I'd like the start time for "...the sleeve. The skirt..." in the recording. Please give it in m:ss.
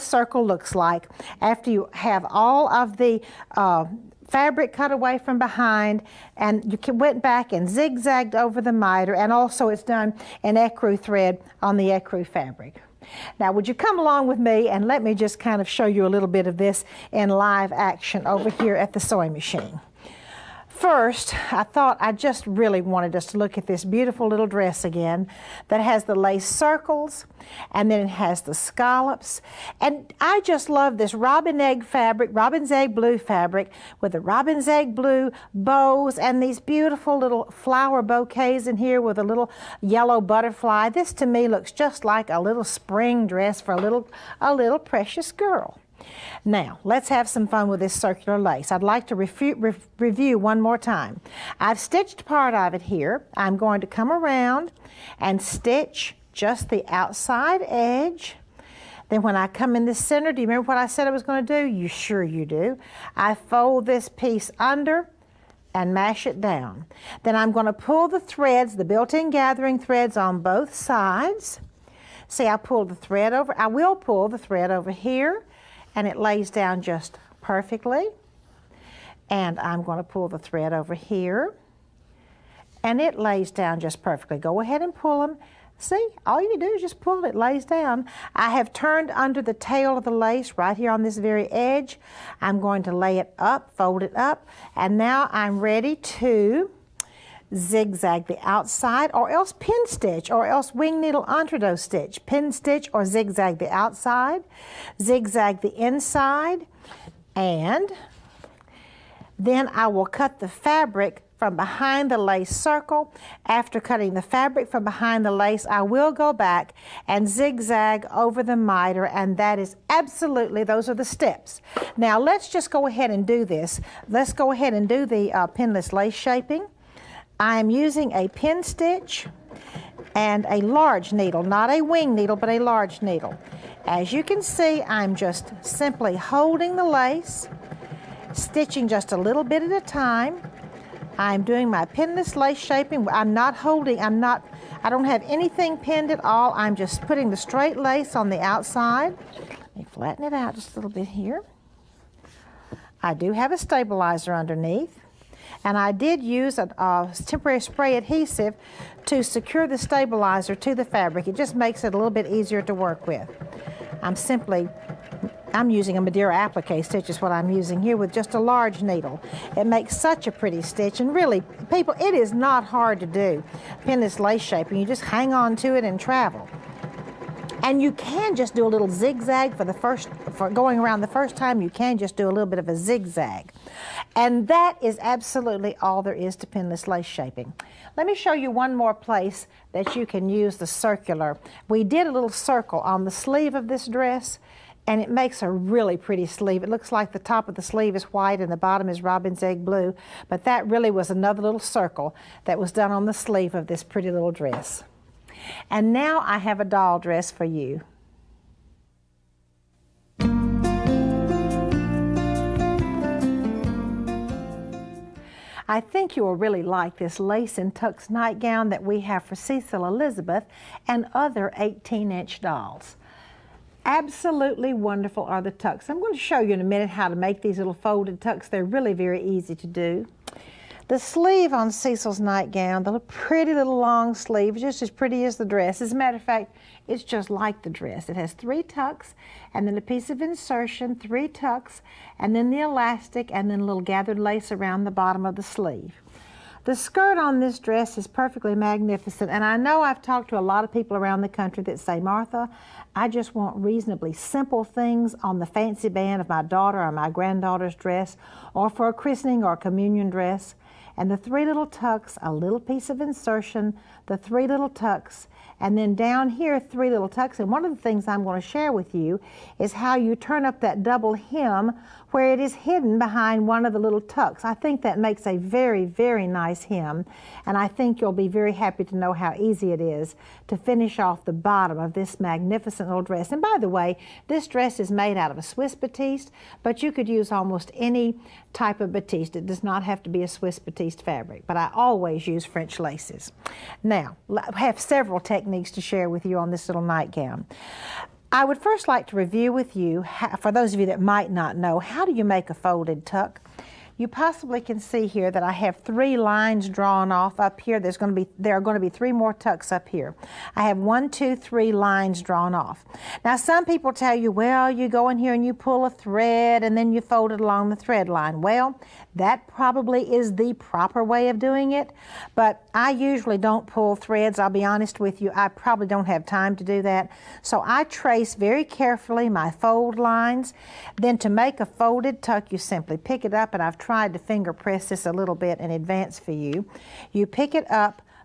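4:05.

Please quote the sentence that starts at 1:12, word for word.
See, I pulled the thread over.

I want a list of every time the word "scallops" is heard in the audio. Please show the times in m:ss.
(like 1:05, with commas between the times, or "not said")
0:28.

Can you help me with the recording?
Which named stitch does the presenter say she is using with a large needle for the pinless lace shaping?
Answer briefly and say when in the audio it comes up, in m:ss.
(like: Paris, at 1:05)
Madeira applique stitch, at 2:45.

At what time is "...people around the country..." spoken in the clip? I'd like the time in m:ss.
4:10.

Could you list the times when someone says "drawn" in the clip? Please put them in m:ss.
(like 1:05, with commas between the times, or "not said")
5:06, 5:12.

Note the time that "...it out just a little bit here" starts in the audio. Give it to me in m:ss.
2:30.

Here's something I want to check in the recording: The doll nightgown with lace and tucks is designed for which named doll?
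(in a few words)
Cecil Elizabeth.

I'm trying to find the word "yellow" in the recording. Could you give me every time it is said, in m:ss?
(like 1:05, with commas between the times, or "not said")
0:39.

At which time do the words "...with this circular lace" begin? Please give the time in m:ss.
0:47.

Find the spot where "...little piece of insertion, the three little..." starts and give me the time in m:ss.
4:22.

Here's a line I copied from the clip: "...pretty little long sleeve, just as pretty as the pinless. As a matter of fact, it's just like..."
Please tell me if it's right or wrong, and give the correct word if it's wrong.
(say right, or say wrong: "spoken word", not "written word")
wrong: "dress", not "pinless".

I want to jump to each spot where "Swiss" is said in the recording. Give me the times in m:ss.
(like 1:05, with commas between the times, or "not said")
4:45, 4:50.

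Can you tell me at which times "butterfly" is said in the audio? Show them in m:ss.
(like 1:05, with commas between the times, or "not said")
0:40.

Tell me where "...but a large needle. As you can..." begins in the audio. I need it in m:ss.
2:12.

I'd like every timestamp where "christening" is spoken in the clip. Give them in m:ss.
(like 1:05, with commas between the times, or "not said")
4:18.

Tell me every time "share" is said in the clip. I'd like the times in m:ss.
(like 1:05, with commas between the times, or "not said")
4:28, 4:55.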